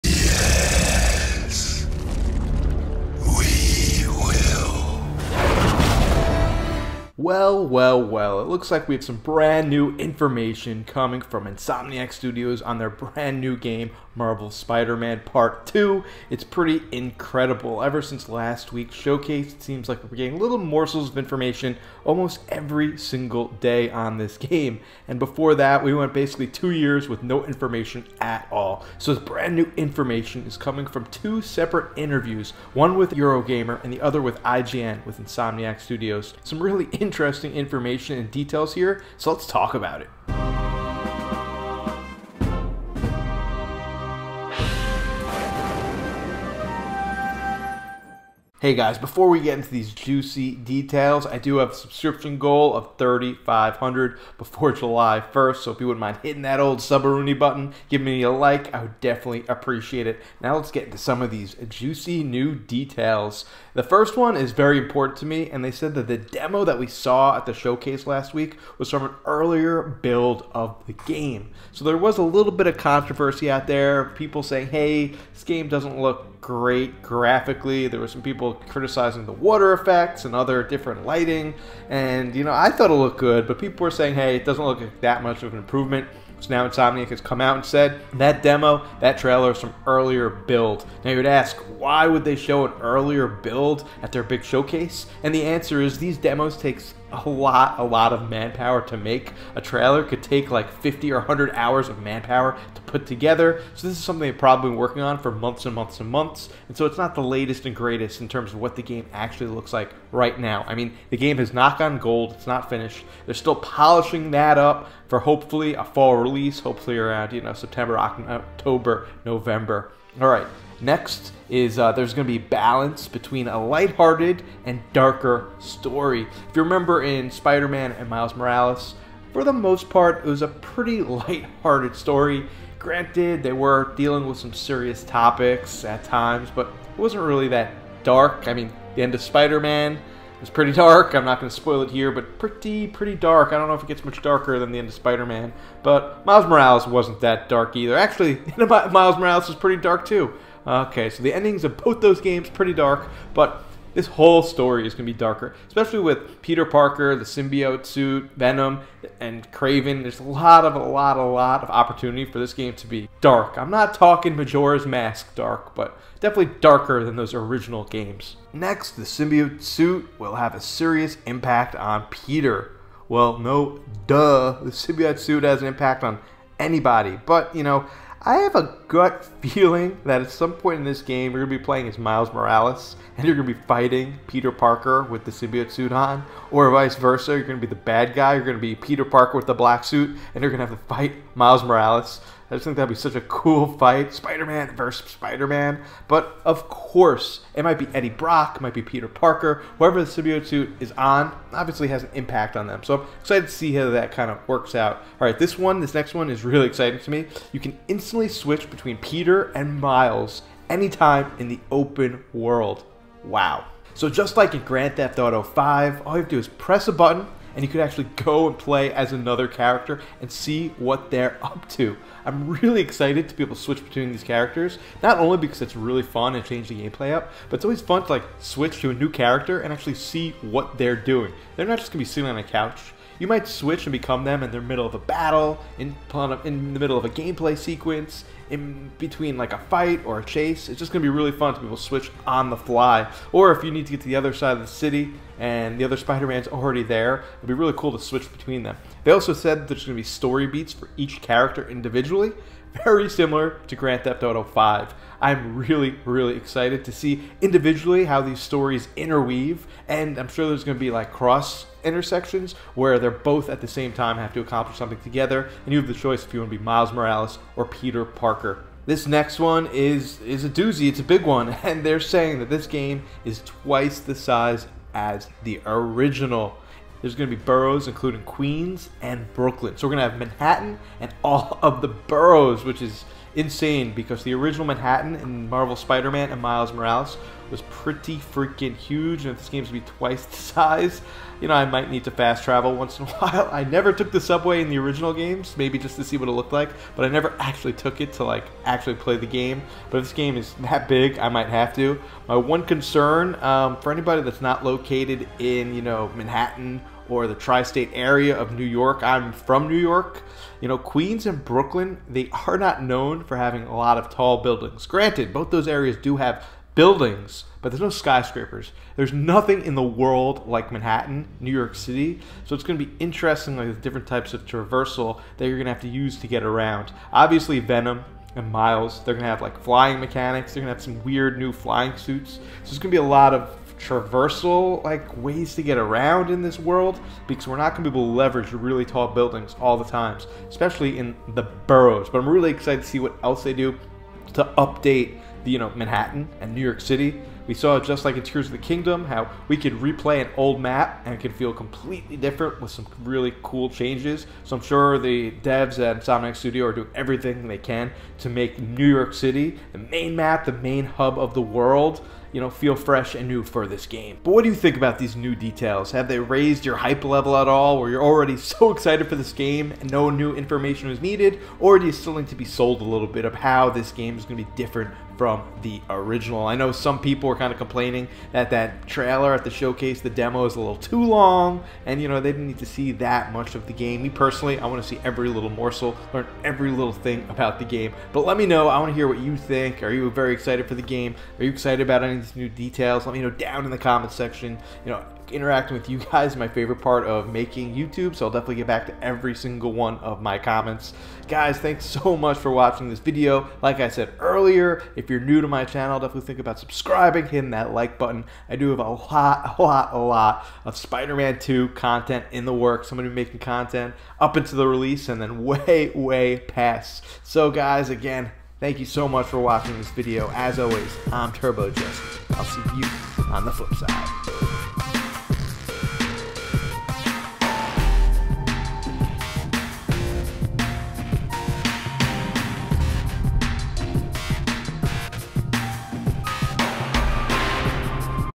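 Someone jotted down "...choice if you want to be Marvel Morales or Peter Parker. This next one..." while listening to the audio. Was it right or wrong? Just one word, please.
wrong.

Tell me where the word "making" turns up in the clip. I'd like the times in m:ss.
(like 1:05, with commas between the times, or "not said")
6:37, 6:53.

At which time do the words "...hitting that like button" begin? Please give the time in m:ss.
6:47.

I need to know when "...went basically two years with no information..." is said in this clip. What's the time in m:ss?
0:25.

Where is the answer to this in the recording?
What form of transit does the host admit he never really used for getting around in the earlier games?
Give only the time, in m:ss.
4:54.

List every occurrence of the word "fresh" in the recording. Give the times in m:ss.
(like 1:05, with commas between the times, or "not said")
6:02.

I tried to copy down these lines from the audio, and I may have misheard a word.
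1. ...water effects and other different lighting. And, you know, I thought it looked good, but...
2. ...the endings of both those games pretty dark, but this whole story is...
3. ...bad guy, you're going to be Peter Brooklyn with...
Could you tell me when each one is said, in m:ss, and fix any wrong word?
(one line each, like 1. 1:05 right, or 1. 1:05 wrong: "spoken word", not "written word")
1. 1:19 right
2. 2:31 right
3. 3:07 wrong: "Parker", not "Brooklyn".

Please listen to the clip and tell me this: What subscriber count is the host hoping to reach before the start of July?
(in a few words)
3,500.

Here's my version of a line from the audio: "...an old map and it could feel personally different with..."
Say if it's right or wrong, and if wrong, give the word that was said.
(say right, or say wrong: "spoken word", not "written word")
wrong: "completely", not "personally".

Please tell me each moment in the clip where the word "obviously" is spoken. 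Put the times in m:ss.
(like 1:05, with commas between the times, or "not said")
3:21, 5:27.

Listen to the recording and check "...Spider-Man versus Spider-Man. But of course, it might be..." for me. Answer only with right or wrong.
right.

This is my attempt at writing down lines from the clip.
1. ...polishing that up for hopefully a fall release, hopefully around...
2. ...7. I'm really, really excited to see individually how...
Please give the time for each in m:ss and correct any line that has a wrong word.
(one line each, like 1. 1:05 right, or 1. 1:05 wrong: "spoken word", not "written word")
1. 1:53 right
2. 4:14 wrong: "5", not "7".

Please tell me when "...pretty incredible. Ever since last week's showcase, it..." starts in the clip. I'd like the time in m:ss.
0:16.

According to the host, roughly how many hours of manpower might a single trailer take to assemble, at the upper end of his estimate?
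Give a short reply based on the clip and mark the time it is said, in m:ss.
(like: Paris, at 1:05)
100, at 1:41.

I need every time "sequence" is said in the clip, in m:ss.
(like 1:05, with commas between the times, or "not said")
3:57.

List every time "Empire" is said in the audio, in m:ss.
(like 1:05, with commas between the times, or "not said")
not said.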